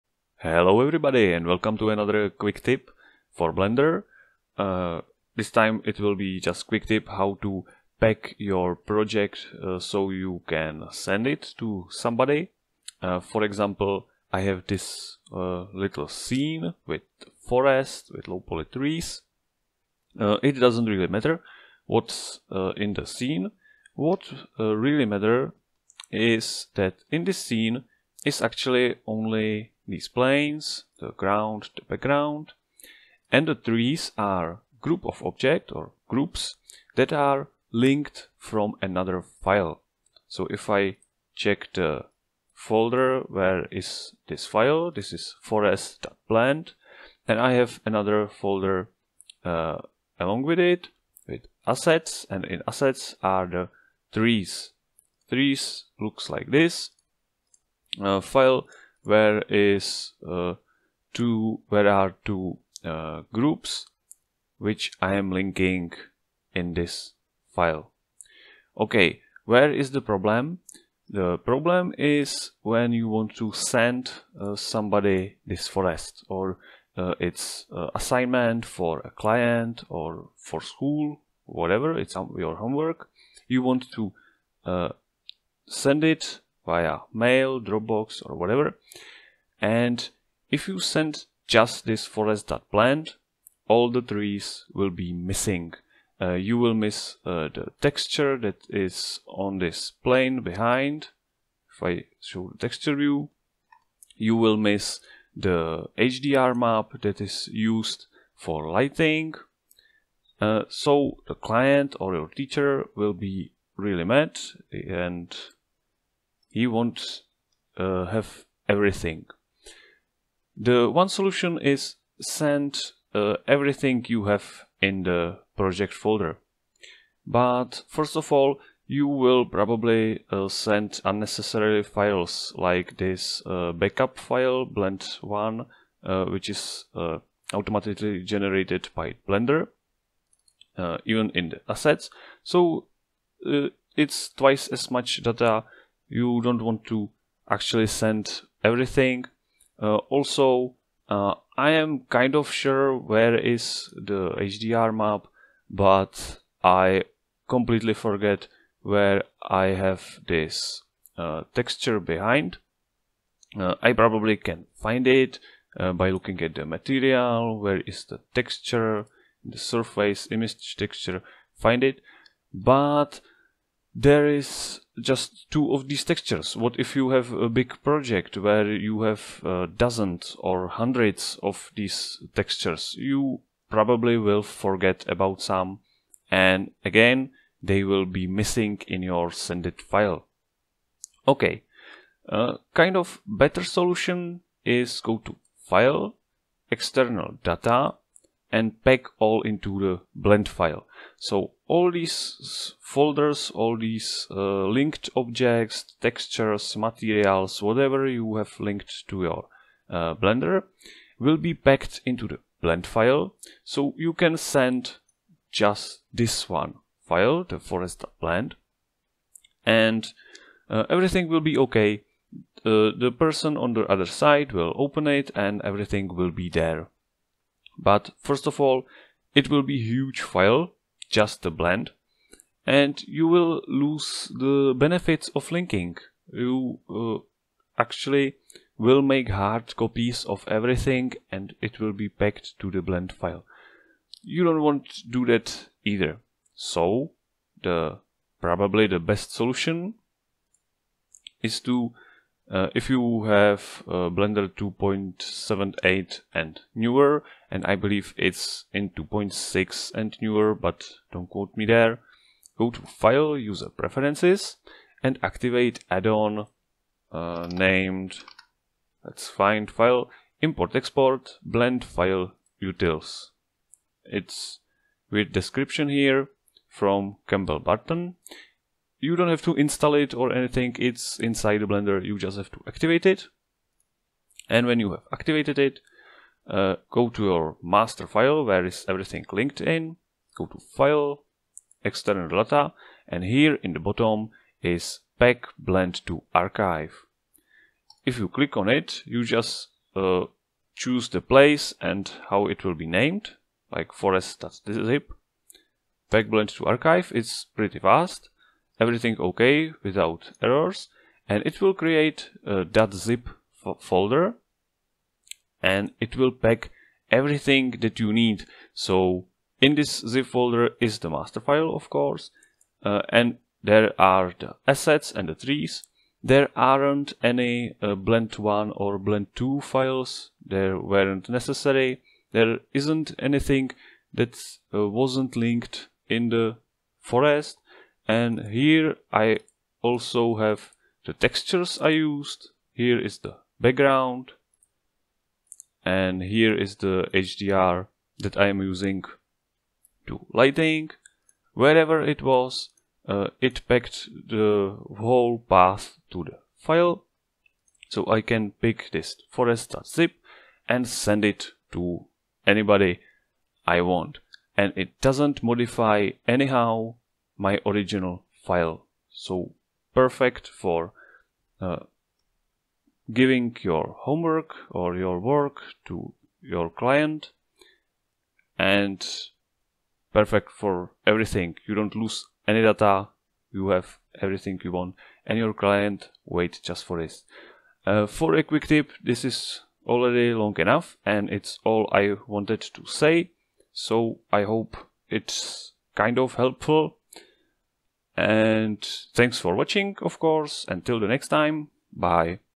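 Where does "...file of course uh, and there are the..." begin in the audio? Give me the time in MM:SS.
05:21.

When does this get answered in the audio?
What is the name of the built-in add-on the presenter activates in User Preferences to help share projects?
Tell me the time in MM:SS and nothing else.
04:31.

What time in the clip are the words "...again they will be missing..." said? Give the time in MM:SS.
03:06.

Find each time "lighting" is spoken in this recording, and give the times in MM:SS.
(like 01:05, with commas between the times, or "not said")
01:48, 05:50.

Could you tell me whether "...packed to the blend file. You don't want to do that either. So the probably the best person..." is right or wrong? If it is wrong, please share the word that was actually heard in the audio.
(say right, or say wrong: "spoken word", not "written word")
wrong: "solution", not "person".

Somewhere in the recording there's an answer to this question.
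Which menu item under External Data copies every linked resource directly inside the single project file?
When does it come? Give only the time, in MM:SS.
03:18.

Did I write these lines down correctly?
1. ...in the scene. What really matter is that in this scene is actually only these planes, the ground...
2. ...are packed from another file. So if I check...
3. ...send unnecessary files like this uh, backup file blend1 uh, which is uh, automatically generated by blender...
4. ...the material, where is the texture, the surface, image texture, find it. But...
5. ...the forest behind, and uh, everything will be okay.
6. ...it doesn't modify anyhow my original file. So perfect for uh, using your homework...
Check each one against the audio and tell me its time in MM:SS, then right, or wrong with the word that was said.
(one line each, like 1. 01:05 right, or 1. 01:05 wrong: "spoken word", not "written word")
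1. 00:22 right
2. 00:37 wrong: "linked", not "packed"
3. 02:10 right
4. 02:46 right
5. 03:37 wrong: "blend", not "behind"
6. 06:04 wrong: "giving", not "using".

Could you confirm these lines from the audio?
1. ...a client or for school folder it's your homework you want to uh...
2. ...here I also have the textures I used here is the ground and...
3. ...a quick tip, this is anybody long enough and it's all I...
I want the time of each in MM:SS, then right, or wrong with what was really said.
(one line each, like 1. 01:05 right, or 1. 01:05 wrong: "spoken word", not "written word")
1. 01:18 wrong: "whatever", not "folder"
2. 05:38 wrong: "background", not "ground"
3. 06:28 wrong: "already", not "anybody".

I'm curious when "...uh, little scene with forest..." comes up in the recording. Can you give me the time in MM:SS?
00:15.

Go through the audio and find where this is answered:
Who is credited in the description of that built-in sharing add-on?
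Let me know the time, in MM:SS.
04:37.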